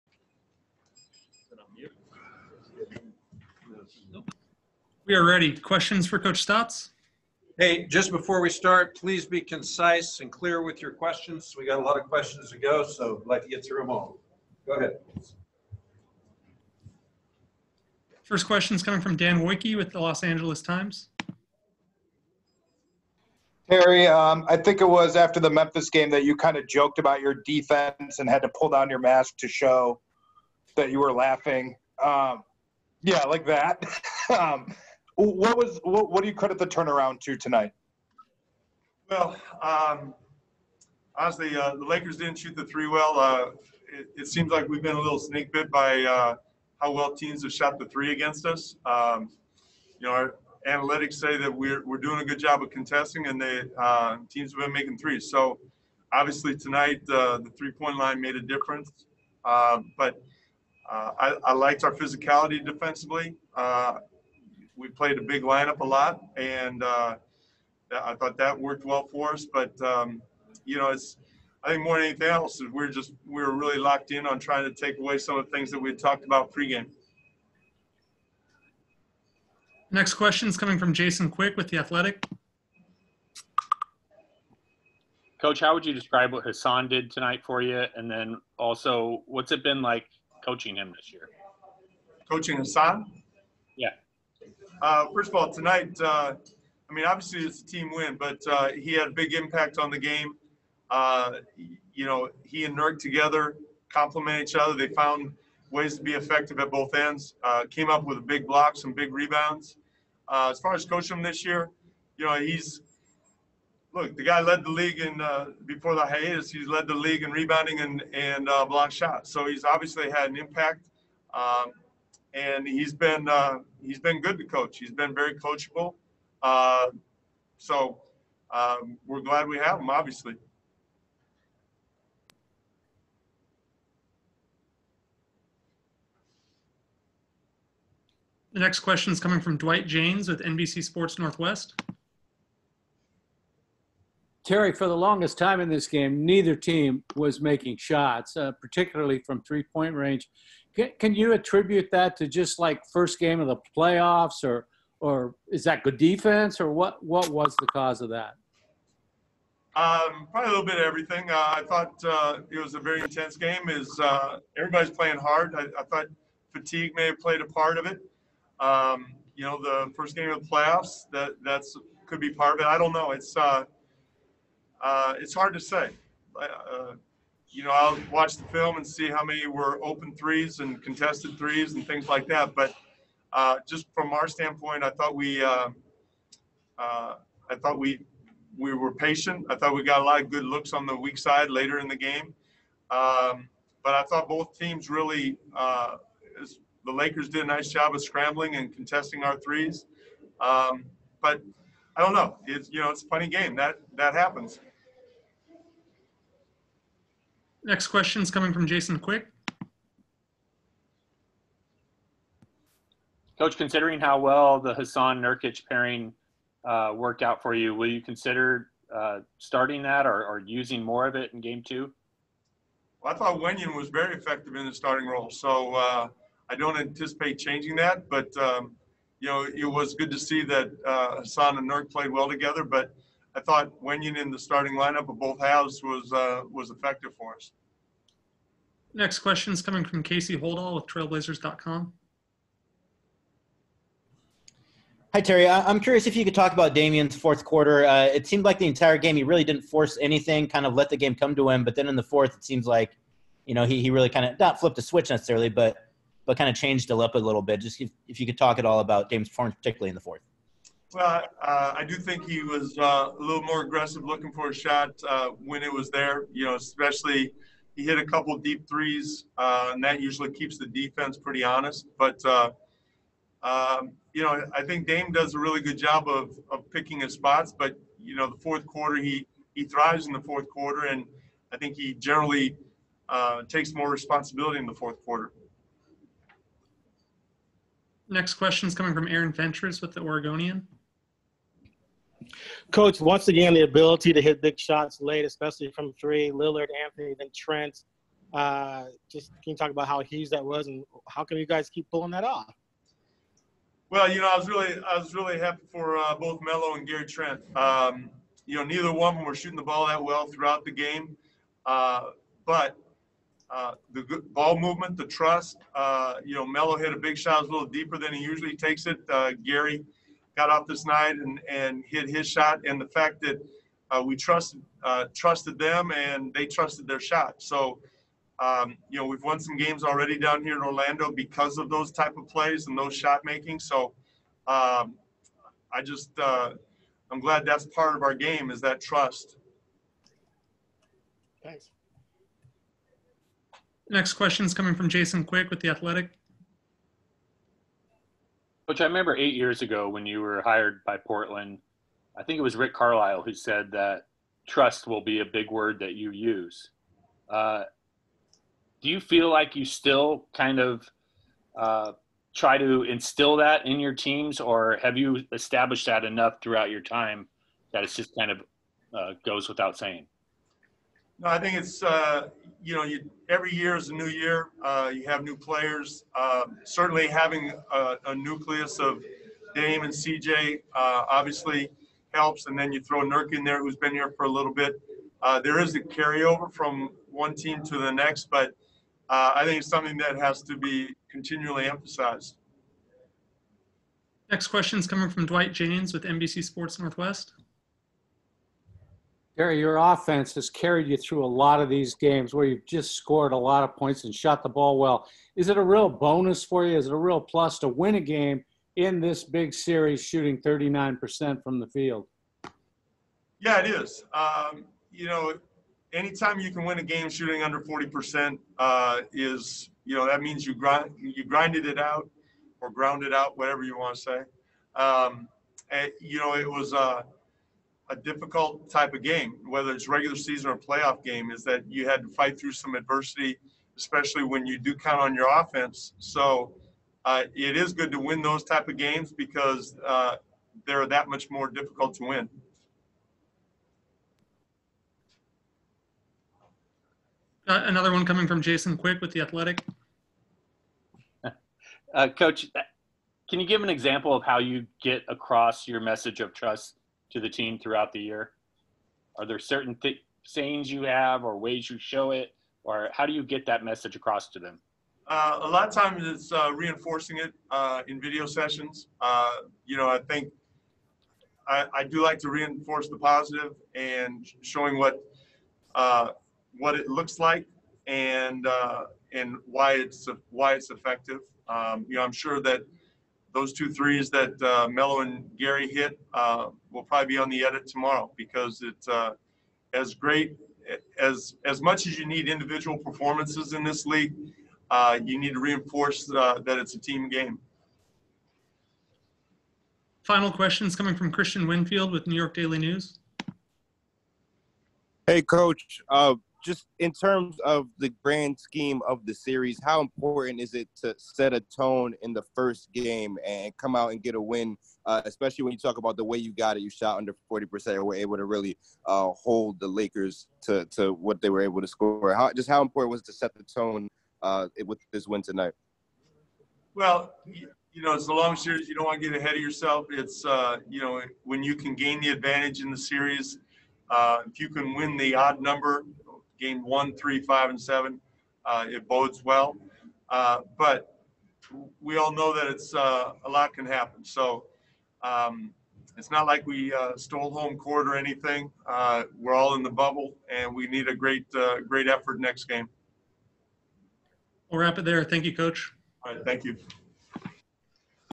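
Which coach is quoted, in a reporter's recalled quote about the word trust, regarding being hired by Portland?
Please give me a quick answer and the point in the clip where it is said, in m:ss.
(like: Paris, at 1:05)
Rick Carlisle, at 5:52.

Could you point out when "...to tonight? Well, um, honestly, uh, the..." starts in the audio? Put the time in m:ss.
0:37.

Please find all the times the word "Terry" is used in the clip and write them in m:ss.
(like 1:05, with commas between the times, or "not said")
0:23, 2:24, 4:05.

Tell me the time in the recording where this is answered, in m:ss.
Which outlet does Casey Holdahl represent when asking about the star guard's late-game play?
4:00.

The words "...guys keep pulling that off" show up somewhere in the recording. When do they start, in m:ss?
5:01.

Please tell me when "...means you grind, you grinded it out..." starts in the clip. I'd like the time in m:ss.
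7:00.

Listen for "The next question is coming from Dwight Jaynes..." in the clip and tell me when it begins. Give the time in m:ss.
2:18.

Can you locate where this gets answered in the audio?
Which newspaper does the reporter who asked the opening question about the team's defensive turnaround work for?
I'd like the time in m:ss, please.
0:19.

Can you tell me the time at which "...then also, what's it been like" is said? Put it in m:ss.
1:28.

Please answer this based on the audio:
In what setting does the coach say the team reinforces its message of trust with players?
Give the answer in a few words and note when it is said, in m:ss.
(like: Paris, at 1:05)
Video sessions, at 7:48.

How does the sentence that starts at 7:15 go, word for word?
So uh, it is good to win those type of games because uh, they're that much more difficult to win.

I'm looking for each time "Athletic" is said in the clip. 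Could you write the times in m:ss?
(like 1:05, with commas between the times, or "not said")
1:21, 5:45, 7:29.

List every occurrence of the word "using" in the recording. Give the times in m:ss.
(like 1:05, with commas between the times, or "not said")
3:40.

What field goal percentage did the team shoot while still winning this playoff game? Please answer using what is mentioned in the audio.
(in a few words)
39%.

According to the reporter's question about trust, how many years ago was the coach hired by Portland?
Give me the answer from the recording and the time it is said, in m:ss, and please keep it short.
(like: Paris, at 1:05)
8, at 5:49.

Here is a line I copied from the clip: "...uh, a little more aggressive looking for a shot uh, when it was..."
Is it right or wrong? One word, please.
right.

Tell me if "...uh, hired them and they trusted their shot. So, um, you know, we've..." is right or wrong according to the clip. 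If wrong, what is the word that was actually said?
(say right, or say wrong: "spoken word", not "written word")
wrong: "trusted", not "hired".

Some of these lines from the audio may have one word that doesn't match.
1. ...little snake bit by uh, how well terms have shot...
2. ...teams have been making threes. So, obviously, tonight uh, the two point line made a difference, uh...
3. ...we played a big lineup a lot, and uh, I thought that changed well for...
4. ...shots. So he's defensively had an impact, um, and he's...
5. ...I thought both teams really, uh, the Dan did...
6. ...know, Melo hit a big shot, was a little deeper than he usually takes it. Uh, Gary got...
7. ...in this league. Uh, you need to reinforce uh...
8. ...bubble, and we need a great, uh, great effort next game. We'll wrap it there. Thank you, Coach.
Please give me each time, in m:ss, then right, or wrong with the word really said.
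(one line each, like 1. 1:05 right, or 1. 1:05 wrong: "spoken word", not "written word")
1. 0:45 wrong: "teams", not "terms"
2. 0:54 wrong: "three", not "two"
3. 1:04 wrong: "worked", not "changed"
4. 1:58 wrong: "obviously", not "defensively"
5. 3:13 wrong: "Lakers", not "Dan"
6. 5:16 right
7. 8:13 right
8. 9:09 right.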